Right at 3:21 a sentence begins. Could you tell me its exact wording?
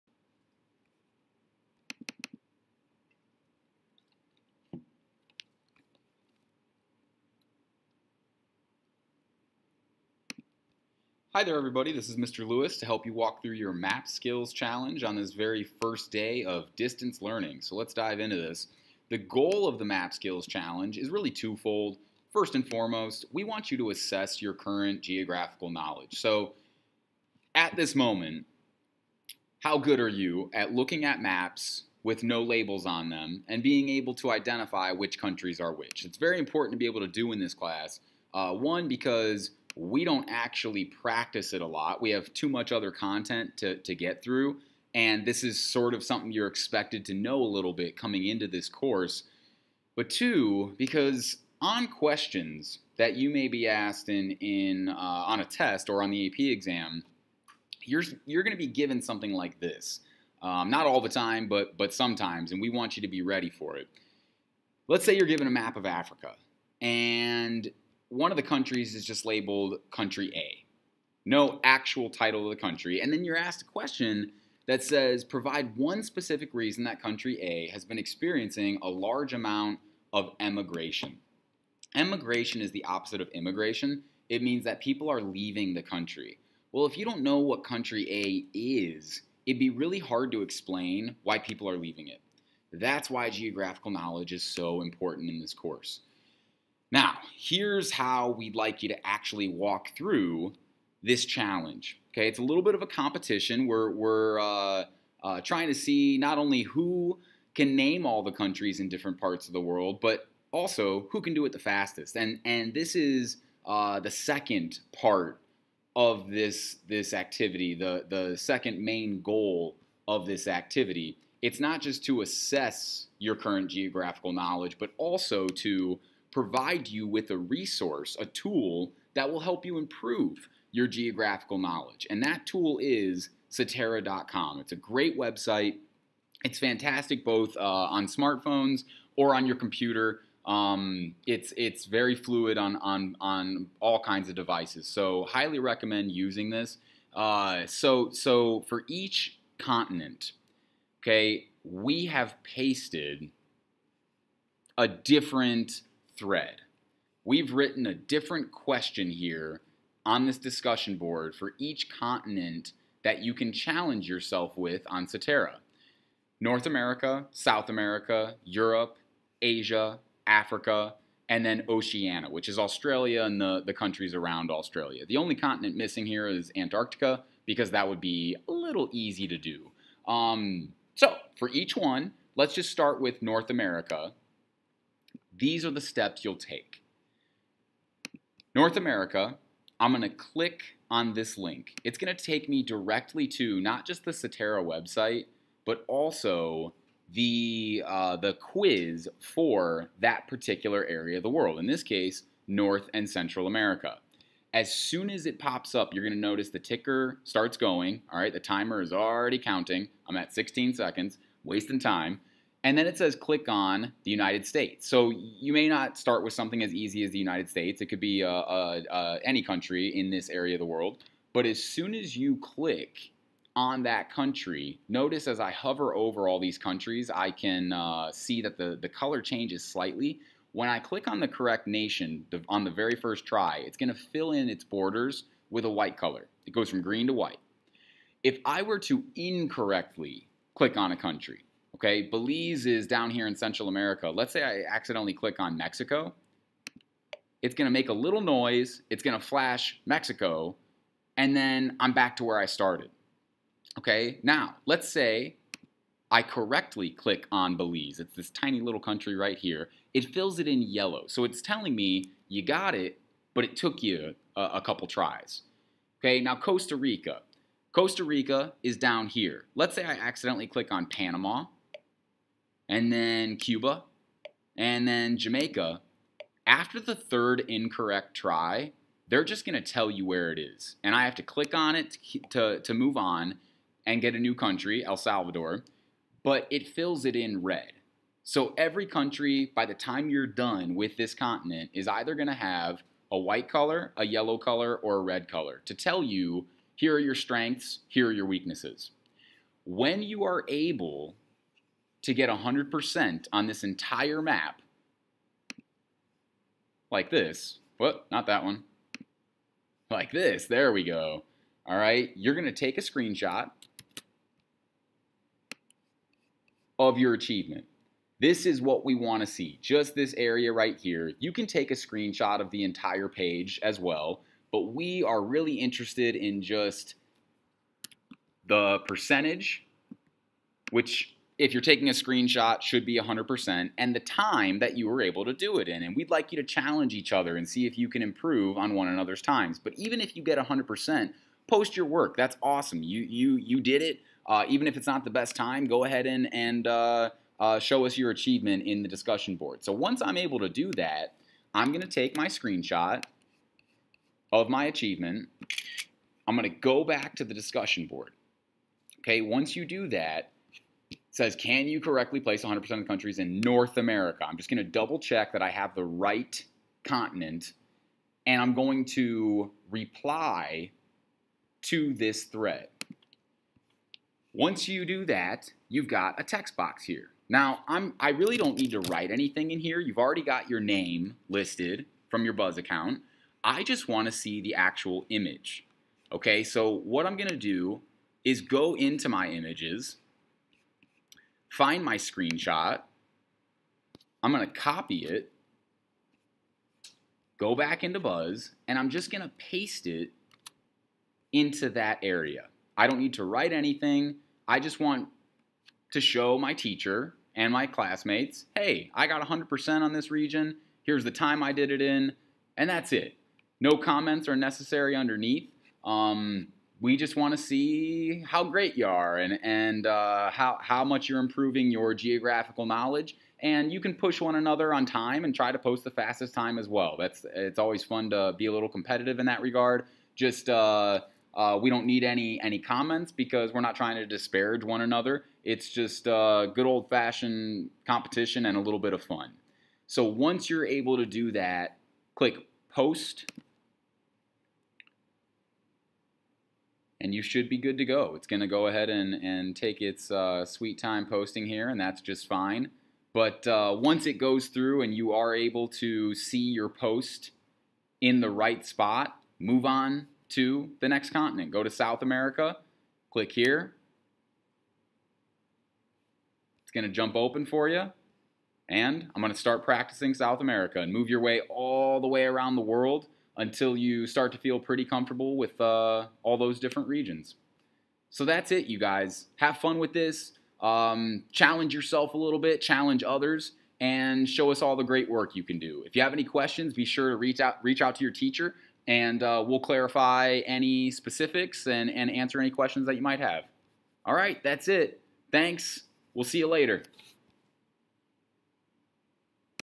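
In this case, North and Central America.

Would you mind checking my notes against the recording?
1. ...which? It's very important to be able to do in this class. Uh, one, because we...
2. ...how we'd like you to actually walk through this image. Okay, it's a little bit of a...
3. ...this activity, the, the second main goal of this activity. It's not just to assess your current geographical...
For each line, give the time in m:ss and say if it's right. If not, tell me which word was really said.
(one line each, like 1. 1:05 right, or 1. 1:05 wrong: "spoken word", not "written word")
1. 0:35 right
2. 1:37 wrong: "challenge", not "image"
3. 1:56 right.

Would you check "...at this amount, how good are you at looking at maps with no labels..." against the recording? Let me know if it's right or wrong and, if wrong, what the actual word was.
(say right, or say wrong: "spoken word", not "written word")
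wrong: "moment", not "amount".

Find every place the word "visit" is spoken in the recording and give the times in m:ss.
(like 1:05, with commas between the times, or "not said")
not said.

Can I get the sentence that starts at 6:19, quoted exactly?
You've already got your name listed from your Buzz account.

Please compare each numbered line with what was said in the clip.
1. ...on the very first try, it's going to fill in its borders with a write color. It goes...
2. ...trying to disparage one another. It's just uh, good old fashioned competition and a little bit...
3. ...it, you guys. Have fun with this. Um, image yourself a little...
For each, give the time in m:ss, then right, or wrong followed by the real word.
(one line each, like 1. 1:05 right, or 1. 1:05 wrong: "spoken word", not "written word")
1. 3:52 wrong: "white", not "write"
2. 7:13 right
3. 7:58 wrong: "challenge", not "image".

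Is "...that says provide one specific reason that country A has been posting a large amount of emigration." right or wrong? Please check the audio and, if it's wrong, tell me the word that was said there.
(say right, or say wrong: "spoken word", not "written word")
wrong: "experiencing", not "posting".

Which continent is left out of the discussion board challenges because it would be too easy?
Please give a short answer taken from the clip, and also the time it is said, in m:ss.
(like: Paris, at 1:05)
Antarctica, at 2:56.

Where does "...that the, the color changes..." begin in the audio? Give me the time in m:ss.
3:48.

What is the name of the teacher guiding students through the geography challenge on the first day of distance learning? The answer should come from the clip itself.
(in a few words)
Mr. Lewis.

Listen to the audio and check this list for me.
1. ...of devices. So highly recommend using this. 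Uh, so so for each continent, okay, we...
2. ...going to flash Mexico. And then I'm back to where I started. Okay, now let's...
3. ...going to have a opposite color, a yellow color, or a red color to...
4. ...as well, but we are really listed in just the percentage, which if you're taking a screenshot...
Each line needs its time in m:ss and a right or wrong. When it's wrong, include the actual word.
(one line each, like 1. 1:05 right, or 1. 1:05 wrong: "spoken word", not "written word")
1. 2:24 right
2. 4:09 right
3. 4:52 wrong: "white", not "opposite"
4. 5:23 wrong: "interested", not "listed".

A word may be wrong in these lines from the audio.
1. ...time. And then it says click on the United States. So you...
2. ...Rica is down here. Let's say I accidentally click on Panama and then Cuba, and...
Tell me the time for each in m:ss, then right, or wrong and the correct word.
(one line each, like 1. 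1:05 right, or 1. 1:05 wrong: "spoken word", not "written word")
1. 3:31 right
2. 4:28 right.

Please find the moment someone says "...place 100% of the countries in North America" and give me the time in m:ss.
6:02.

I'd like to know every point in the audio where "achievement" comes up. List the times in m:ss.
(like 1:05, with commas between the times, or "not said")
5:17, 5:48, 5:54.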